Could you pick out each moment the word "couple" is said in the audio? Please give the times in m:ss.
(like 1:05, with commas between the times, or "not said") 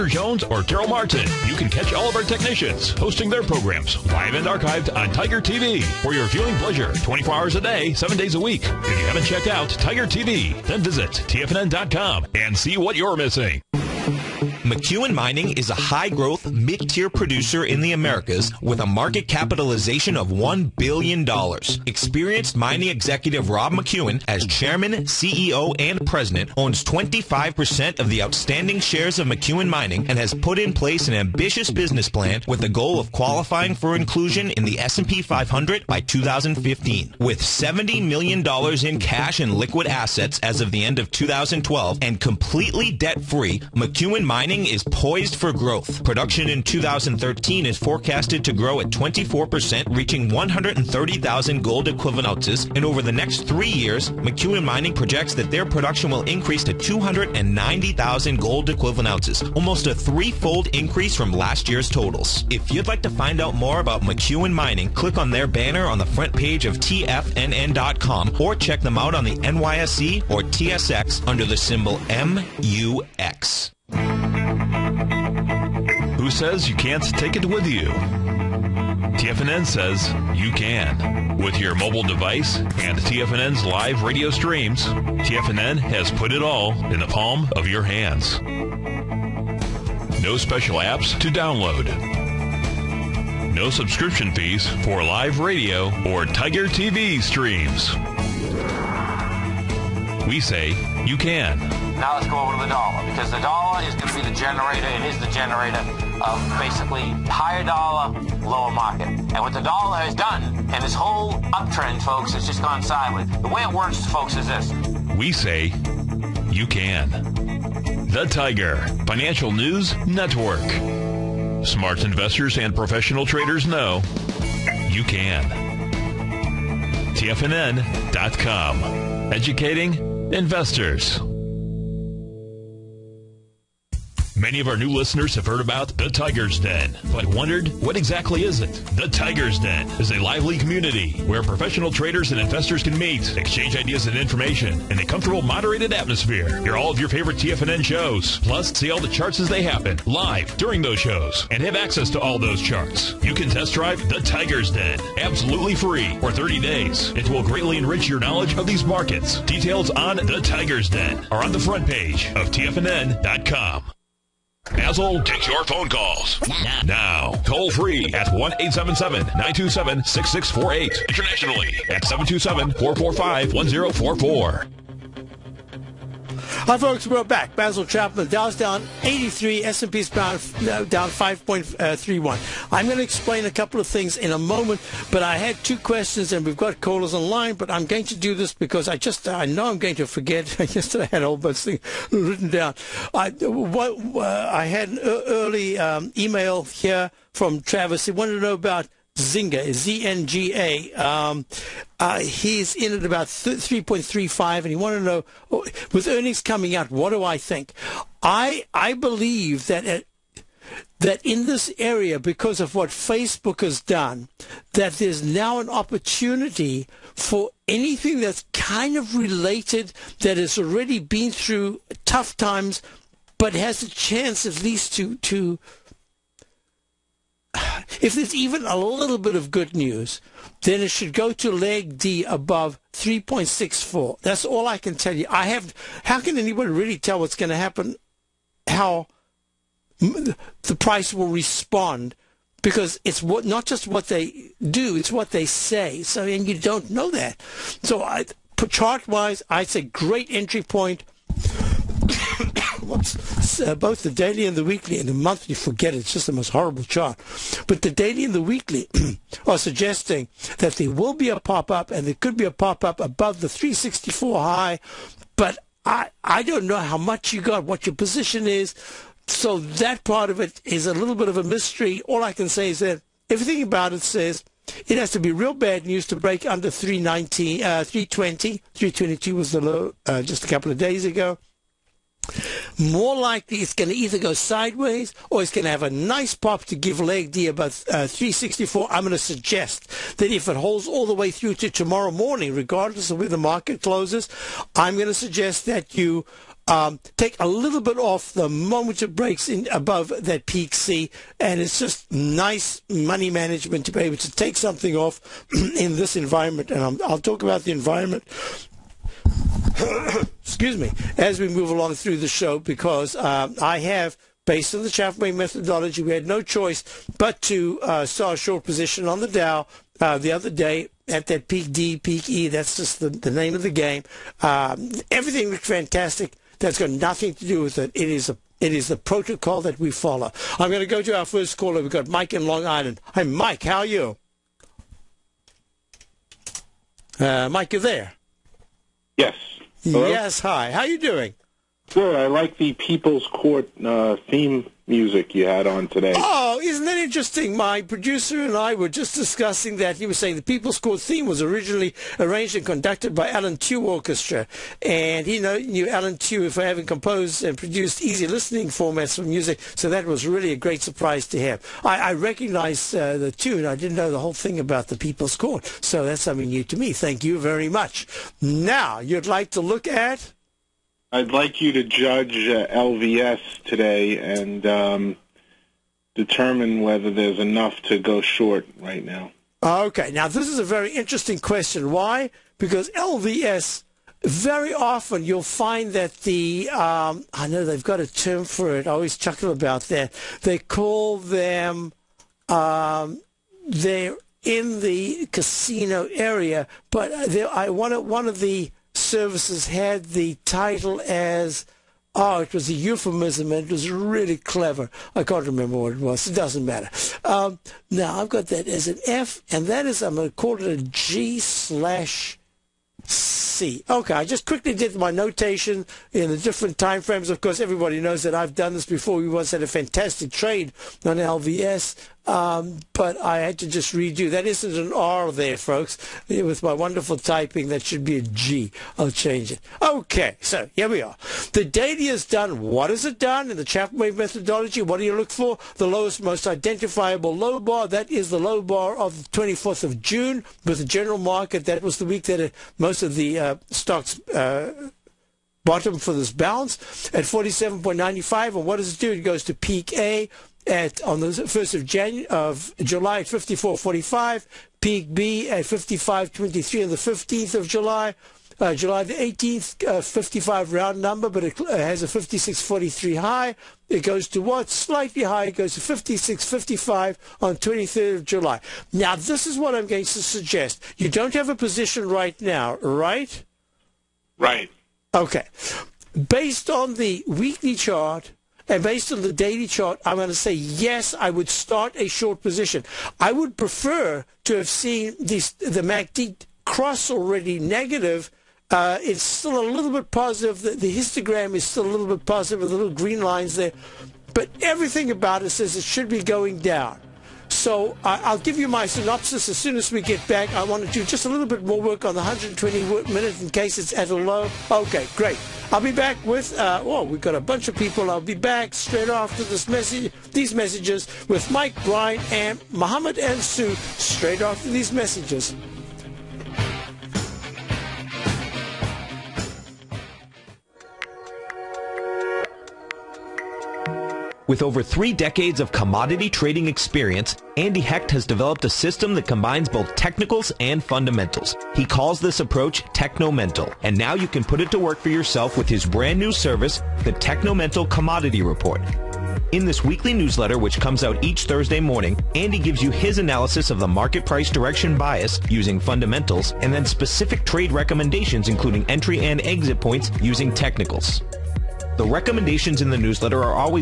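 3:03, 4:40.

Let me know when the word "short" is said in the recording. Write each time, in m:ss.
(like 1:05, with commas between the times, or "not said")
5:18, 6:18, 8:02.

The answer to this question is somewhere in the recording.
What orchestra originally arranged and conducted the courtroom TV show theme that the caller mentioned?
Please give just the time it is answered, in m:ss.
5:53.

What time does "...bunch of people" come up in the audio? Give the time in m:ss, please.
8:27.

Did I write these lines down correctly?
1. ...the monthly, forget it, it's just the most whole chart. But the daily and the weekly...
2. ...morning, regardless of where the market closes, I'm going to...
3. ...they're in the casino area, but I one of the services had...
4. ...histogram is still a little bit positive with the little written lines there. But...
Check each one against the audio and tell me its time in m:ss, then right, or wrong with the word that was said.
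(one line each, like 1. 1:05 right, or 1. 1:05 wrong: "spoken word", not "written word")
1. 4:15 wrong: "horrible", not "whole"
2. 4:52 right
3. 6:33 right
4. 8:10 wrong: "green", not "written".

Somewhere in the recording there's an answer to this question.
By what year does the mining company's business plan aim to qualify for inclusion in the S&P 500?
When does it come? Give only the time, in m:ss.
0:36.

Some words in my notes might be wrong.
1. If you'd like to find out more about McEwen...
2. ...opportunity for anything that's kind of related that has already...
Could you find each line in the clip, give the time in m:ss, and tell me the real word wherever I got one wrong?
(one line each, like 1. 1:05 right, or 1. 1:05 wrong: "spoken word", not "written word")
1. 1:02 right
2. 3:35 right.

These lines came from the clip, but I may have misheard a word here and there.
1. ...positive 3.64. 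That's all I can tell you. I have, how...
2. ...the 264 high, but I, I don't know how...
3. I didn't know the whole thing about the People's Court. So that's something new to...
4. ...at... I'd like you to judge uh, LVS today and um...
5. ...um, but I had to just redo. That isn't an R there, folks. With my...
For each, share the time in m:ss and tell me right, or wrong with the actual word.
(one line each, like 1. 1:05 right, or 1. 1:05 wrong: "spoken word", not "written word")
1. 3:52 wrong: "above", not "positive"
2. 4:23 wrong: "364", not "264"
3. 6:03 right
4. 6:09 right
5. 7:02 right.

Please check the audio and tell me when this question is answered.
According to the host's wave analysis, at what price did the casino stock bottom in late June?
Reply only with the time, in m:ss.
7:27.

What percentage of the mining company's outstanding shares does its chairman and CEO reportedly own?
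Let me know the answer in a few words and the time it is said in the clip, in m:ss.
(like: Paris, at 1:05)
25%, at 0:26.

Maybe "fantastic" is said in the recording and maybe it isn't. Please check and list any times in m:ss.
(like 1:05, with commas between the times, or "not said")
5:25, 6:59.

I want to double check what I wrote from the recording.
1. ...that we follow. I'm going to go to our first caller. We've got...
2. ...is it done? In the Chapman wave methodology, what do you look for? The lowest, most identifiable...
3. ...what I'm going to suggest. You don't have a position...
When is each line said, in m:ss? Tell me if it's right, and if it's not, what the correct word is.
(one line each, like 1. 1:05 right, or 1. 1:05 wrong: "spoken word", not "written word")
1. 5:29 right
2. 7:12 right
3. 7:49 right.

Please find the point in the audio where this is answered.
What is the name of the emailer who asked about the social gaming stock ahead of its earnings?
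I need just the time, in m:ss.
3:17.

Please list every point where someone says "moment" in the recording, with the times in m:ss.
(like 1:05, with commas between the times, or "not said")
3:04, 4:58.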